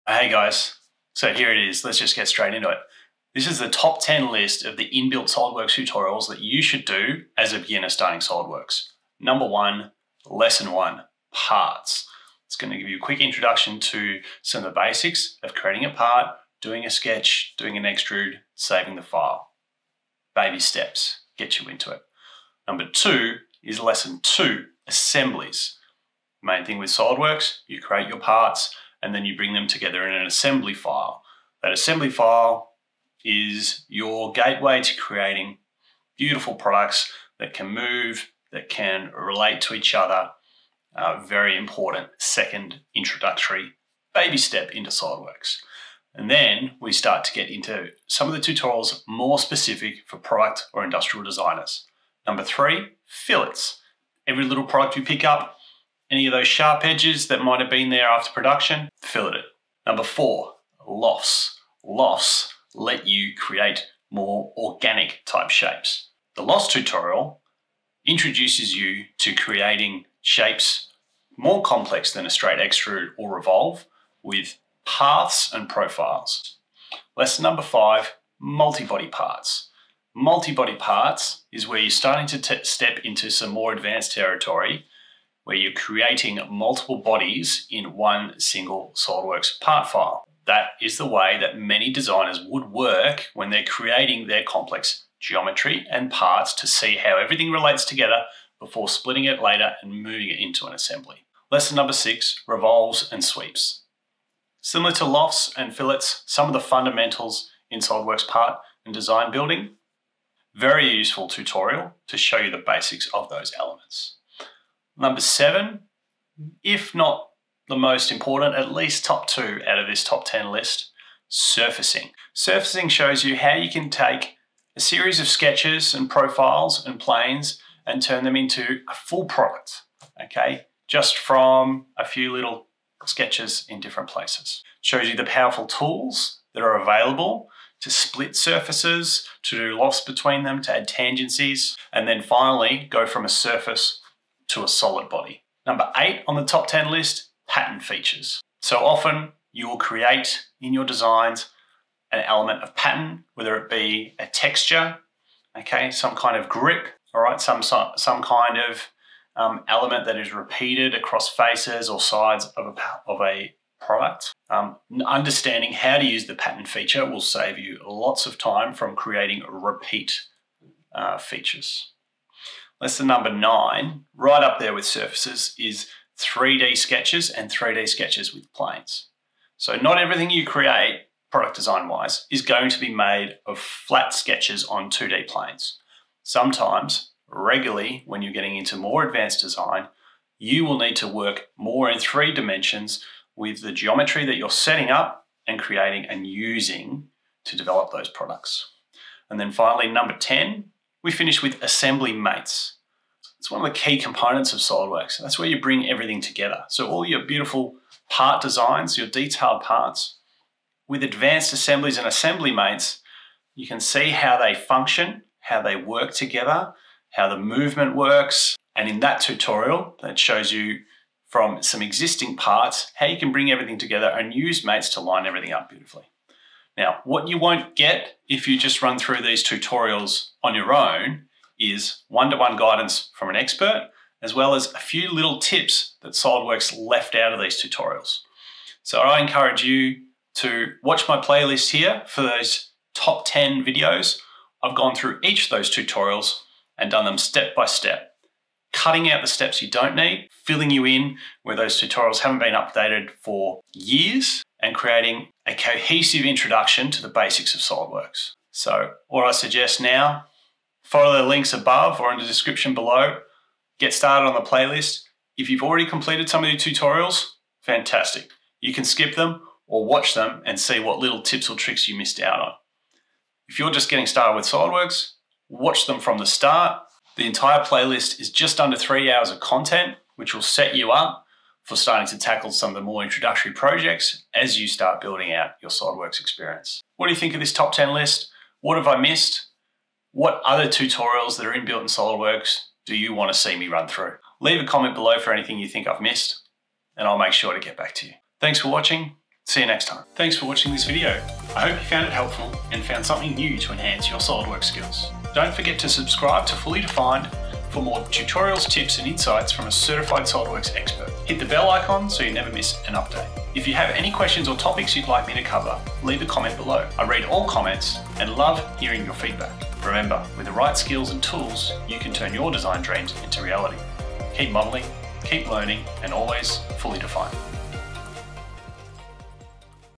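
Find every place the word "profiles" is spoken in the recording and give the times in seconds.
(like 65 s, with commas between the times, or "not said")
75 s, 126 s.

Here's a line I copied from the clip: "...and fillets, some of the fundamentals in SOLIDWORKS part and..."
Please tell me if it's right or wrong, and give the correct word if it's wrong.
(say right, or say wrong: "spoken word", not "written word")
right.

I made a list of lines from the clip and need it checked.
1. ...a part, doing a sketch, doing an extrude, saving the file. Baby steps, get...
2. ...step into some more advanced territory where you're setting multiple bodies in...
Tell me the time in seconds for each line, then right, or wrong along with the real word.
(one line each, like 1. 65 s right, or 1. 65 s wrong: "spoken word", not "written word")
1. 15 s right
2. 82 s wrong: "creating", not "setting".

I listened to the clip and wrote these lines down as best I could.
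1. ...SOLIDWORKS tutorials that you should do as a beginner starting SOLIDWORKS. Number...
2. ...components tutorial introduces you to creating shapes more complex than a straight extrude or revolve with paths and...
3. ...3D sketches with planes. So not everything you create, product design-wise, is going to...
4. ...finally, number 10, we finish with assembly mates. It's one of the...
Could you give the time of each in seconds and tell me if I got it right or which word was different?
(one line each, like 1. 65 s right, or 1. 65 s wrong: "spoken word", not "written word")
1. 5 s right
2. 66 s wrong: "lofts", not "components"
3. 177 s right
4. 199 s right.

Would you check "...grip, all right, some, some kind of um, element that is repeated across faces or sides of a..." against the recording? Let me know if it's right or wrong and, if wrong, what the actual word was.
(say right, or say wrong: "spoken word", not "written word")
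right.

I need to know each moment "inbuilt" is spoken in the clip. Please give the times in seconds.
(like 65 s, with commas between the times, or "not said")
4 s, 291 s.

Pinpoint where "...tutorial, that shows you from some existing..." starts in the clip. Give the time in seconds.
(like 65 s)
219 s.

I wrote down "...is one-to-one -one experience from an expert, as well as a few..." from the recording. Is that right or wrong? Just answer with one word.
wrong.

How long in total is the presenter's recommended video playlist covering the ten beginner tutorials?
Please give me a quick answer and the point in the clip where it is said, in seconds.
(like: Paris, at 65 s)
Just under 3 hours, at 278 s.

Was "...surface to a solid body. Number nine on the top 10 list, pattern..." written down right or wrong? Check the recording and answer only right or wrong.
wrong.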